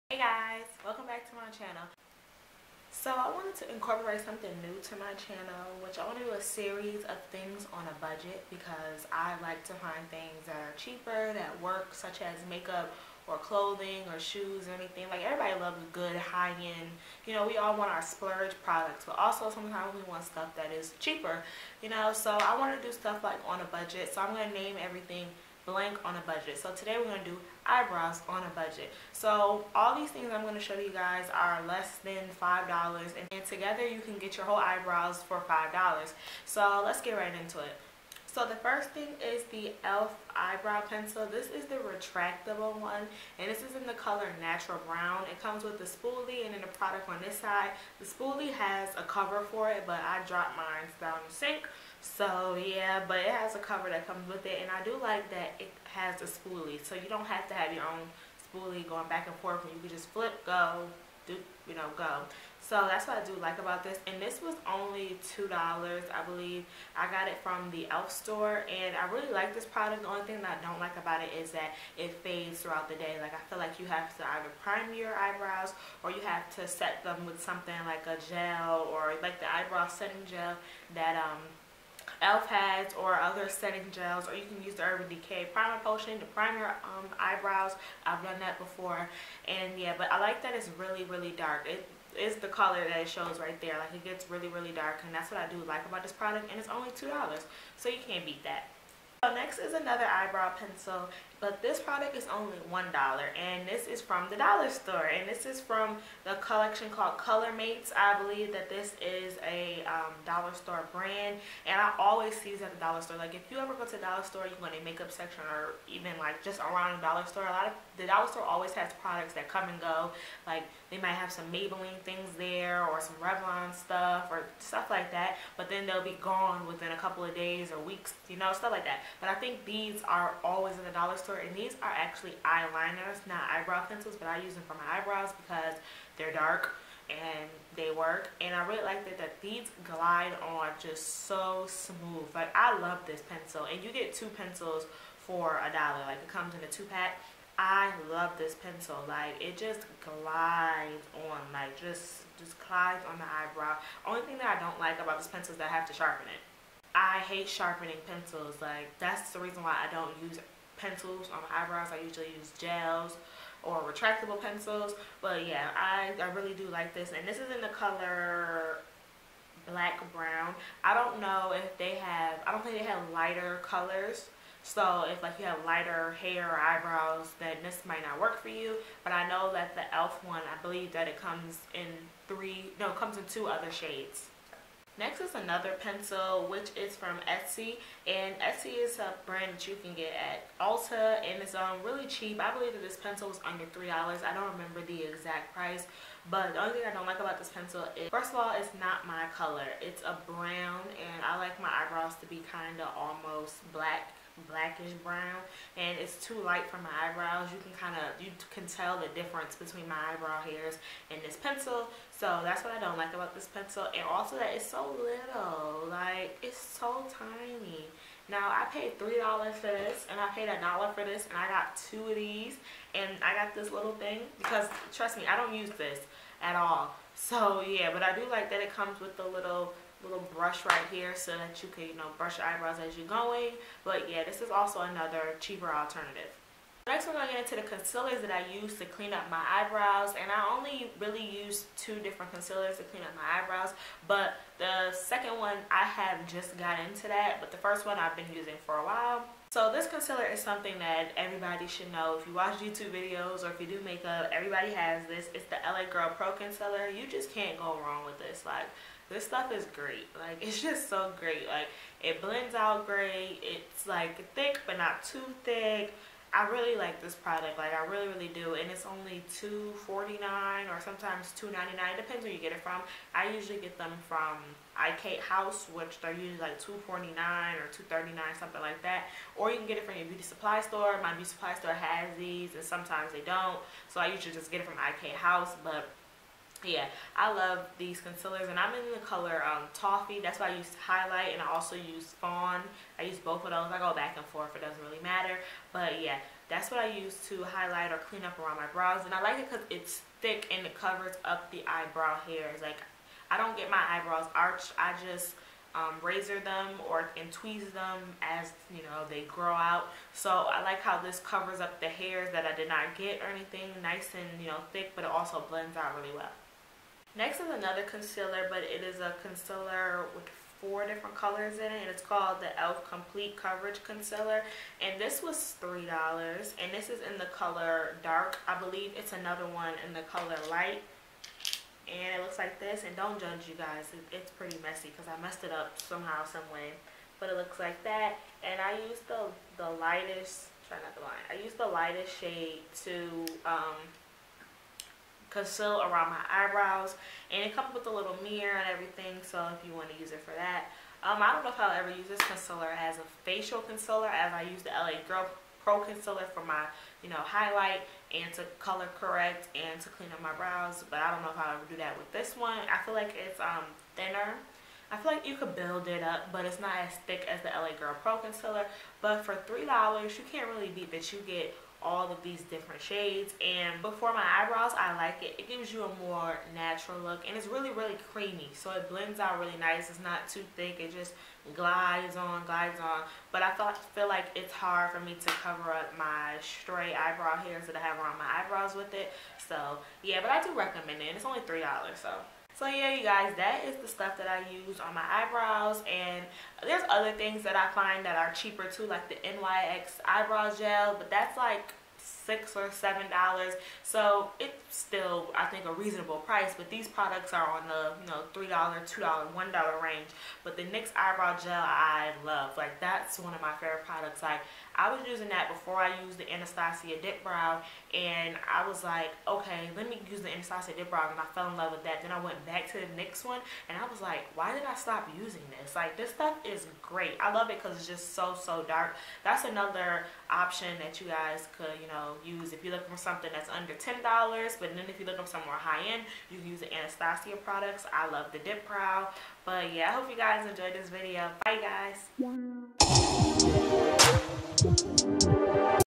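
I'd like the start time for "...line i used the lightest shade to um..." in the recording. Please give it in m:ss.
5:41.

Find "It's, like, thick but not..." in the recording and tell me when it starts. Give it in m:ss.
4:23.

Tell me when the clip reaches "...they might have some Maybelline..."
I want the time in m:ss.
2:00.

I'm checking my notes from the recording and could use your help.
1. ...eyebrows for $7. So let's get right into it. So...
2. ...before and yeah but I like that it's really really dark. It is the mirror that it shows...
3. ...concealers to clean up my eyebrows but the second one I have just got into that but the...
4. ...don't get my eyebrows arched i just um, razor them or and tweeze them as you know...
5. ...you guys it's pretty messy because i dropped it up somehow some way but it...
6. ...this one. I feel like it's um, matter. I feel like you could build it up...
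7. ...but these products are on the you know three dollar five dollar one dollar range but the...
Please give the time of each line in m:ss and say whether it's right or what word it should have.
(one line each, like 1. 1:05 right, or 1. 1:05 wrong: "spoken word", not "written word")
1. 0:34 wrong: "5", not "7"
2. 1:28 wrong: "color", not "mirror"
3. 4:02 right
4. 5:03 right
5. 5:33 wrong: "messed", not "dropped"
6. 6:02 wrong: "thinner", not "matter"
7. 6:46 wrong: "two", not "five".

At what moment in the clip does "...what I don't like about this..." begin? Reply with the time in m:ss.
3:32.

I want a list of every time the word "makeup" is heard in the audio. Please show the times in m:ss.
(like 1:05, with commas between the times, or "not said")
0:12, 1:54, 4:13.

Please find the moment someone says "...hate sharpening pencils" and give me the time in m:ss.
2:37.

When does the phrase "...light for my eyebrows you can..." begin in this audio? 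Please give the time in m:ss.
3:26.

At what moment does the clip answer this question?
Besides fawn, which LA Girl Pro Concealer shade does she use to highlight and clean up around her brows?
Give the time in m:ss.
4:49.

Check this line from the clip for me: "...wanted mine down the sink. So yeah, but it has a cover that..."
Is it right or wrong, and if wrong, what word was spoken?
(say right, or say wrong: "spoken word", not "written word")
wrong: "dropped", not "wanted".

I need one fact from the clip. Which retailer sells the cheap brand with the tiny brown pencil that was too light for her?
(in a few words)
Ulta.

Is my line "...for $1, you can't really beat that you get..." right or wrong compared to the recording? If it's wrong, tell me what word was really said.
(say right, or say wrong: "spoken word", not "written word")
wrong: "3", not "1".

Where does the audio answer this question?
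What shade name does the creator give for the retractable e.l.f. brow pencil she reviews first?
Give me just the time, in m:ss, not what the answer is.
0:44.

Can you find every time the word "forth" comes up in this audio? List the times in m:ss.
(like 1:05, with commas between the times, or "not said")
0:59, 4:54.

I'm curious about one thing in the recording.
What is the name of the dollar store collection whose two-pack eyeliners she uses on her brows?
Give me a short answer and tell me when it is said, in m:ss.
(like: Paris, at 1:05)
Color Mates, at 1:47.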